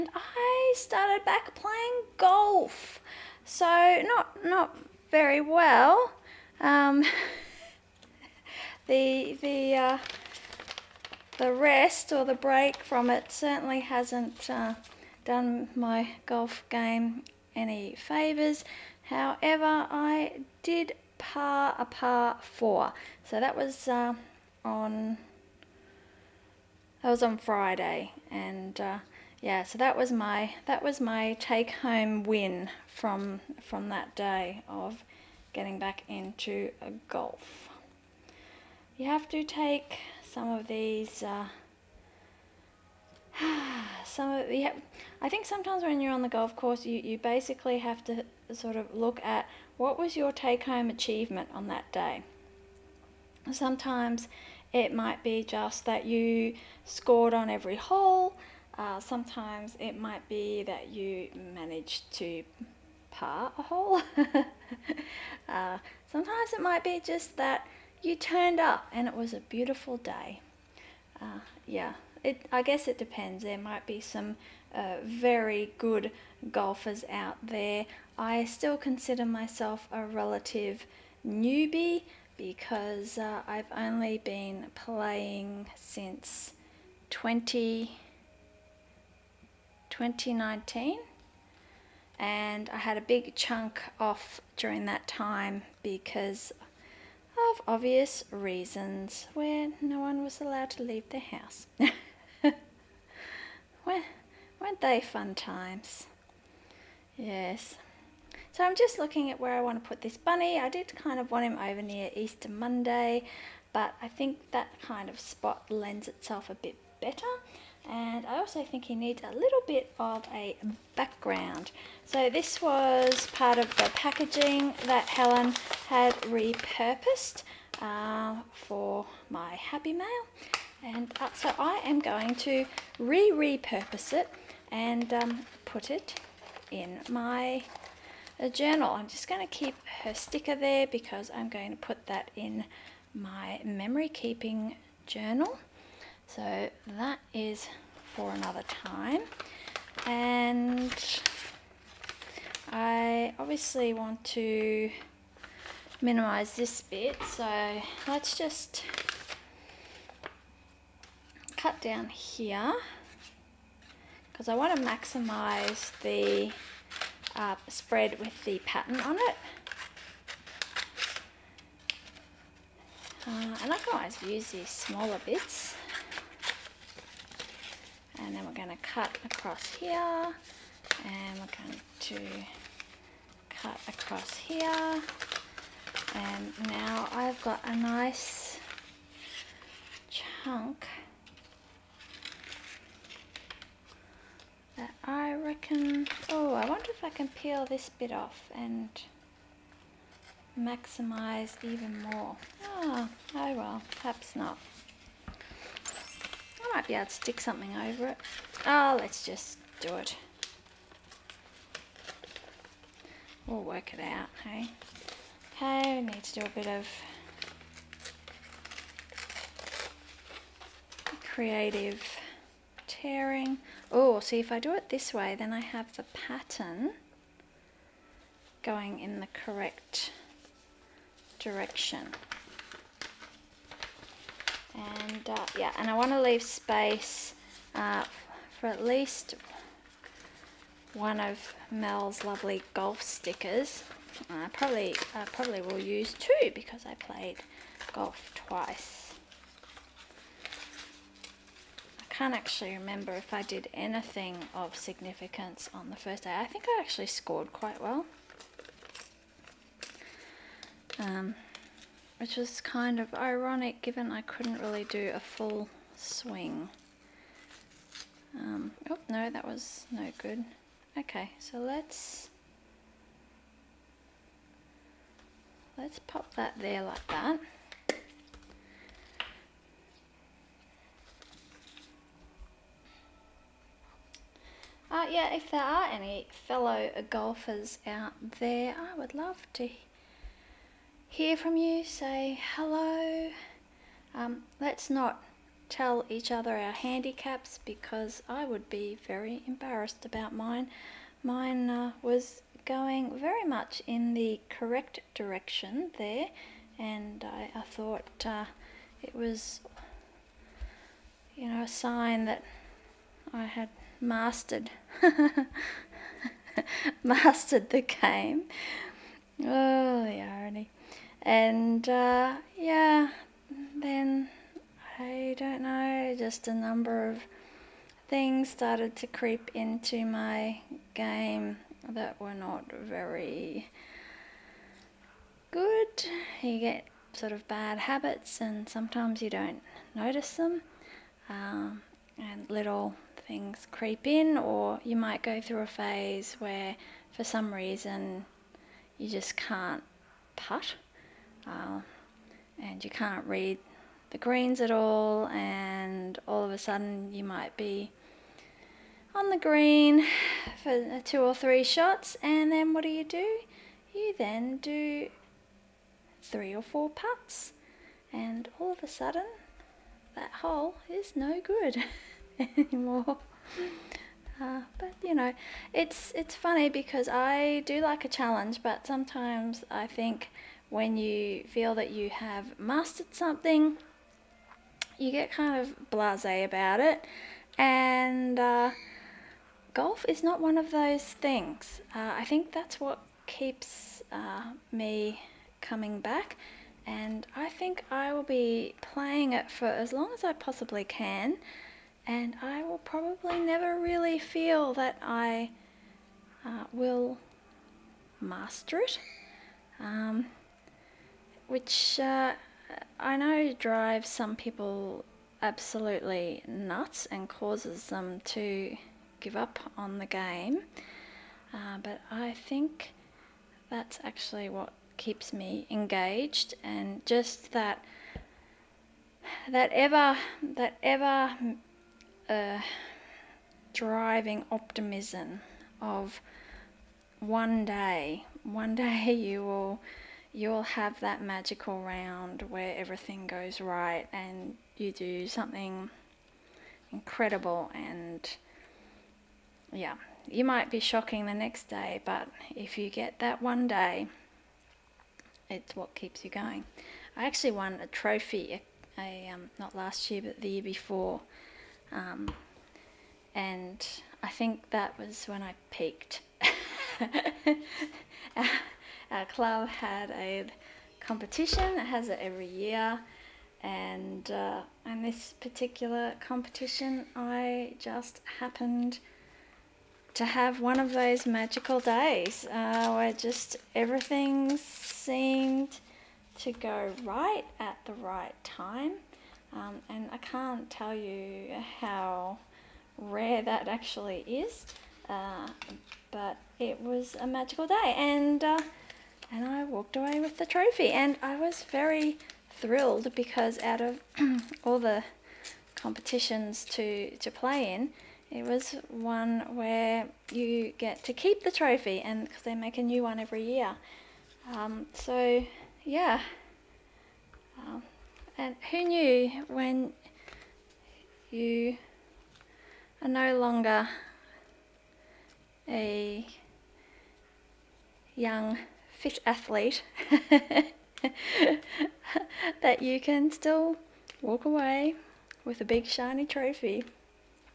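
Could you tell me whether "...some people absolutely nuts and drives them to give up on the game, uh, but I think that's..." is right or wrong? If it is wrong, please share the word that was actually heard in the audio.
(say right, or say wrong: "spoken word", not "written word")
wrong: "causes", not "drives".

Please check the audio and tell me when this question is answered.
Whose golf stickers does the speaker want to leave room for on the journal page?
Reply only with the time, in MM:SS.
04:01.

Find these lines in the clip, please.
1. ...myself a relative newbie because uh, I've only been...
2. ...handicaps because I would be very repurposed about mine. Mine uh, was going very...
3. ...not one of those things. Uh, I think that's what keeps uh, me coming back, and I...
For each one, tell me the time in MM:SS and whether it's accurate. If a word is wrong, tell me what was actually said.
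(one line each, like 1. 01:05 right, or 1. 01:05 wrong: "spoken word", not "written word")
1. 01:19 right
2. 04:56 wrong: "embarrassed", not "repurposed"
3. 06:30 right.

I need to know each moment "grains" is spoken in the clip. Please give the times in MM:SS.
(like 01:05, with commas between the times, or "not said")
not said.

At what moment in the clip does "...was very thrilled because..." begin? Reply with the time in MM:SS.
08:21.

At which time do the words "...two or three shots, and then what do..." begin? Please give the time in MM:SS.
06:01.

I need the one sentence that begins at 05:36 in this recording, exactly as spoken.
You get sort of bad habits, and sometimes you don't notice them.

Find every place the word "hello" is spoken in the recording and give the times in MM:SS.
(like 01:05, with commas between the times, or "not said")
04:52.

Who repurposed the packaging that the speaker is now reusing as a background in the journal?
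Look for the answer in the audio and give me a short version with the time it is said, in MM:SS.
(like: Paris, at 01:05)
Helen, at 02:05.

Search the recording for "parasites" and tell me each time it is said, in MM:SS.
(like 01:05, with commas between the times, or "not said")
not said.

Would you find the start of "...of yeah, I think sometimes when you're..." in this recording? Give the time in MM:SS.
00:44.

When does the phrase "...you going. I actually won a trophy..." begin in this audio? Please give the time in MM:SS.
07:36.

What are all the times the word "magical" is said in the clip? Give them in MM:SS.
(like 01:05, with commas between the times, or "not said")
07:21, 08:01, 08:17.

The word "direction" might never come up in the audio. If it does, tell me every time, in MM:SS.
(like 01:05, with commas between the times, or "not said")
03:51, 05:05.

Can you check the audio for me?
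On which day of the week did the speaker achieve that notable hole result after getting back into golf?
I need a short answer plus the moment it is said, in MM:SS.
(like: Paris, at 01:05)
Friday, at 00:27.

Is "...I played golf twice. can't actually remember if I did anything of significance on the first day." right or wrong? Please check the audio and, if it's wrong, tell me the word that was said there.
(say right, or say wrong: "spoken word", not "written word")
right.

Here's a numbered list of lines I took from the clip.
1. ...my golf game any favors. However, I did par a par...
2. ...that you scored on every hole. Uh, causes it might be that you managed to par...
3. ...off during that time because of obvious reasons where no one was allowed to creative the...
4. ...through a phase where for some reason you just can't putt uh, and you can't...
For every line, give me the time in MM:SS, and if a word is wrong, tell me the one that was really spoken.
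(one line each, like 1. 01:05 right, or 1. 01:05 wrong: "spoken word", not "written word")
1. 00:15 right
2. 00:55 wrong: "sometimes", not "causes"
3. 01:33 wrong: "leave", not "creative"
4. 05:45 right.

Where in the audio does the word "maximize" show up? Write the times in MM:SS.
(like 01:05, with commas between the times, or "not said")
02:44, 03:20.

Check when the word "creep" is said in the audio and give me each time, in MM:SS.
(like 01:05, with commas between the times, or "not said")
05:29, 05:43.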